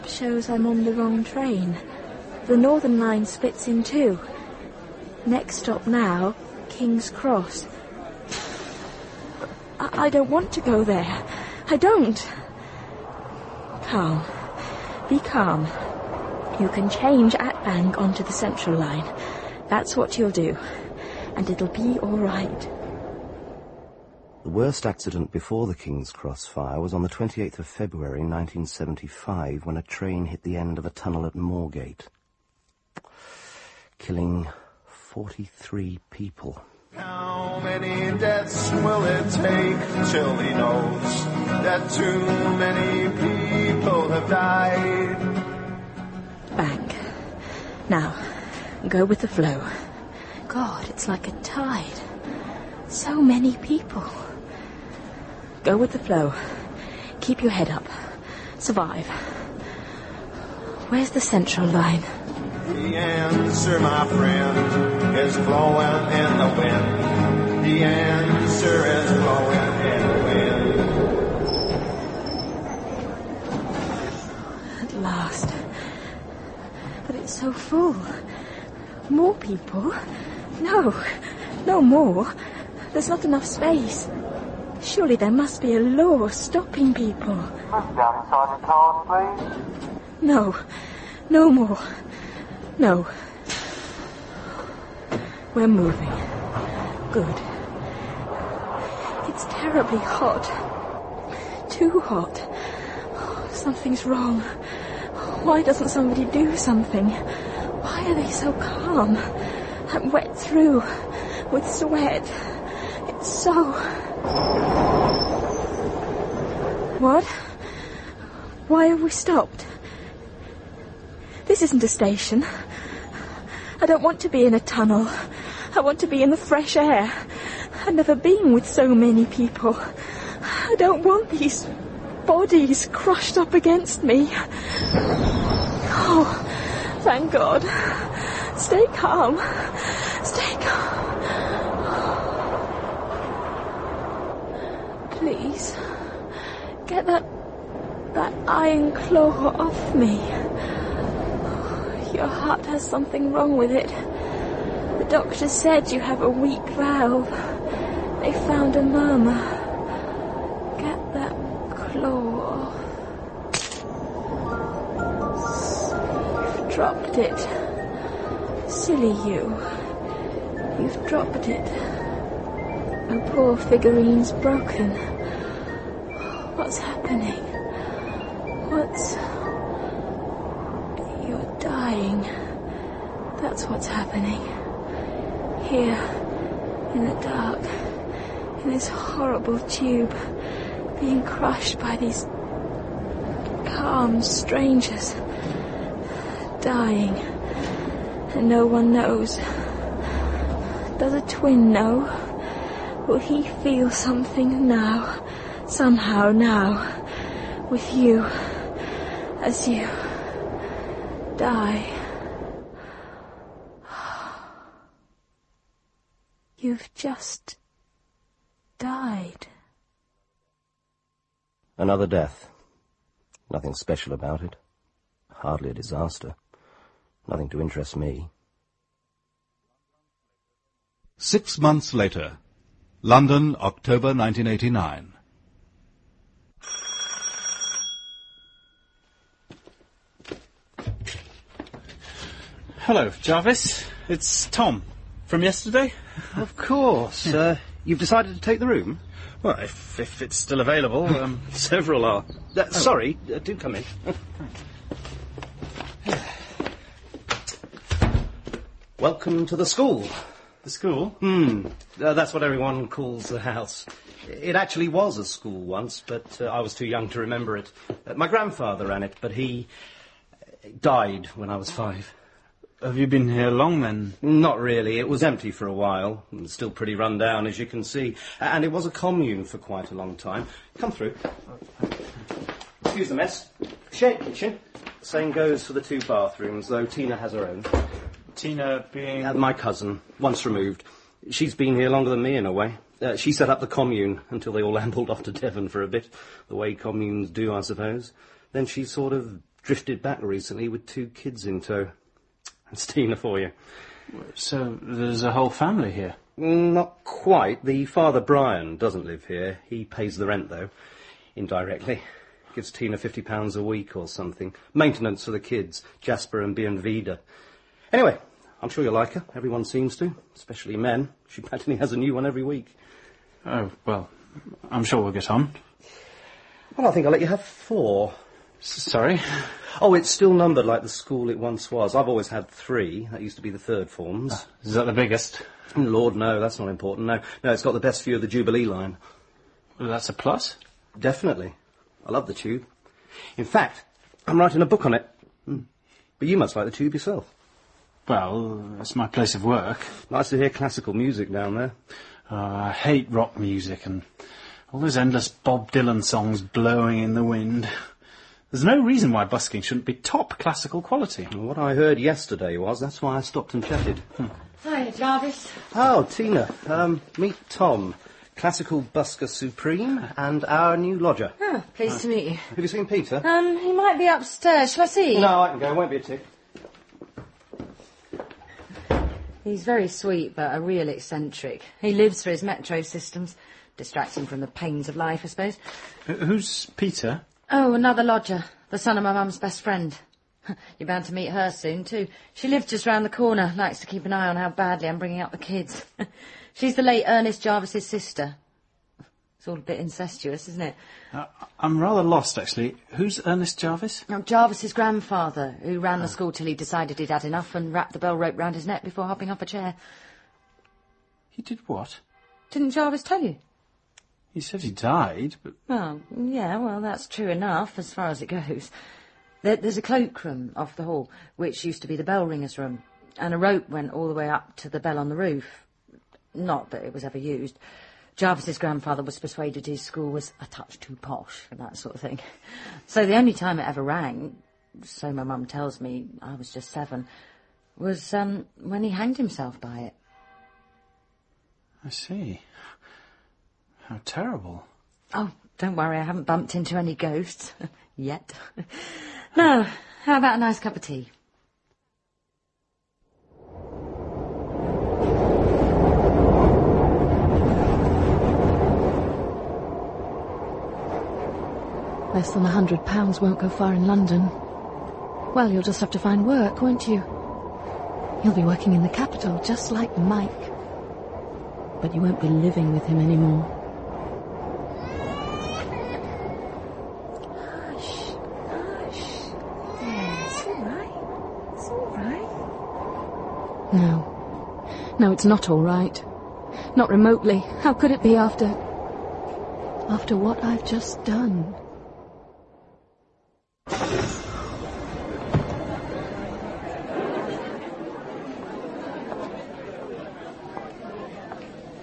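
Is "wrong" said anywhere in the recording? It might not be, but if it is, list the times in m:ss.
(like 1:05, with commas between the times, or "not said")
0:00, 1:44, 2:33.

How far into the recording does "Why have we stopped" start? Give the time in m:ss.
1:58.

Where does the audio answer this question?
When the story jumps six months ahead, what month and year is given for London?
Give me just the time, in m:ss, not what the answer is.
3:53.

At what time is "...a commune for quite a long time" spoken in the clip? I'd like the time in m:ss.
4:38.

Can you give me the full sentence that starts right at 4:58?
Then she sort of drifted back recently with two kids in tow.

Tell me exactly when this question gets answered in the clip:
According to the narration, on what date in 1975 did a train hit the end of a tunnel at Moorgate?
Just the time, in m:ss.
0:27.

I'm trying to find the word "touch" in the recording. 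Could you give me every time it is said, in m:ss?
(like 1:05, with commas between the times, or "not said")
7:10.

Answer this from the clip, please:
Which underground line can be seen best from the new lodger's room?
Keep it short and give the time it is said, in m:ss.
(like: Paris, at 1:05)
Jubilee line, at 5:38.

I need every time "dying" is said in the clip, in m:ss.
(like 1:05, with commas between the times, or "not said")
3:01, 3:16.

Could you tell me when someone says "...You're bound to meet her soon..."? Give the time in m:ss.
6:30.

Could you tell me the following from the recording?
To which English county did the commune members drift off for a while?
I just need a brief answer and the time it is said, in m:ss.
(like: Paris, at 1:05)
Devon, at 4:55.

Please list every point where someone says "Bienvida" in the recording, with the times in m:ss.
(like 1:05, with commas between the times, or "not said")
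5:16.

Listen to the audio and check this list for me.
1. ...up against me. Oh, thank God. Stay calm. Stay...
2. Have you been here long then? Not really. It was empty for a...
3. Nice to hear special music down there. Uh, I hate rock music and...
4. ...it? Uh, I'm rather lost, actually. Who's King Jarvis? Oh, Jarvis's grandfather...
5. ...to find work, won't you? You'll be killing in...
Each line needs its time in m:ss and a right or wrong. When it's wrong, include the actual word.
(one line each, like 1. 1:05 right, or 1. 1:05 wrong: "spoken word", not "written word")
1. 2:13 right
2. 4:32 right
3. 5:50 wrong: "classical", not "special"
4. 6:40 wrong: "Ernest", not "King"
5. 7:45 wrong: "working", not "killing".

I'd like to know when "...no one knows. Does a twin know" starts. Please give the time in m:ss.
3:18.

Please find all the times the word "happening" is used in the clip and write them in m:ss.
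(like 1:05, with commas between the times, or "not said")
2:57, 3:03.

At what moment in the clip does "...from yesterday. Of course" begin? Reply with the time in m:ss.
4:05.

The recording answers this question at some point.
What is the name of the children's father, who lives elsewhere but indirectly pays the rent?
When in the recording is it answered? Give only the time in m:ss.
5:08.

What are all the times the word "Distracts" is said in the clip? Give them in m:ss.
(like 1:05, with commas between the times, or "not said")
6:23.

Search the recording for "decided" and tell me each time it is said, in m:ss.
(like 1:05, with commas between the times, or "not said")
4:07, 6:46.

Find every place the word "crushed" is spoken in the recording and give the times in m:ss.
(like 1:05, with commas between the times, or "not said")
2:12, 3:11.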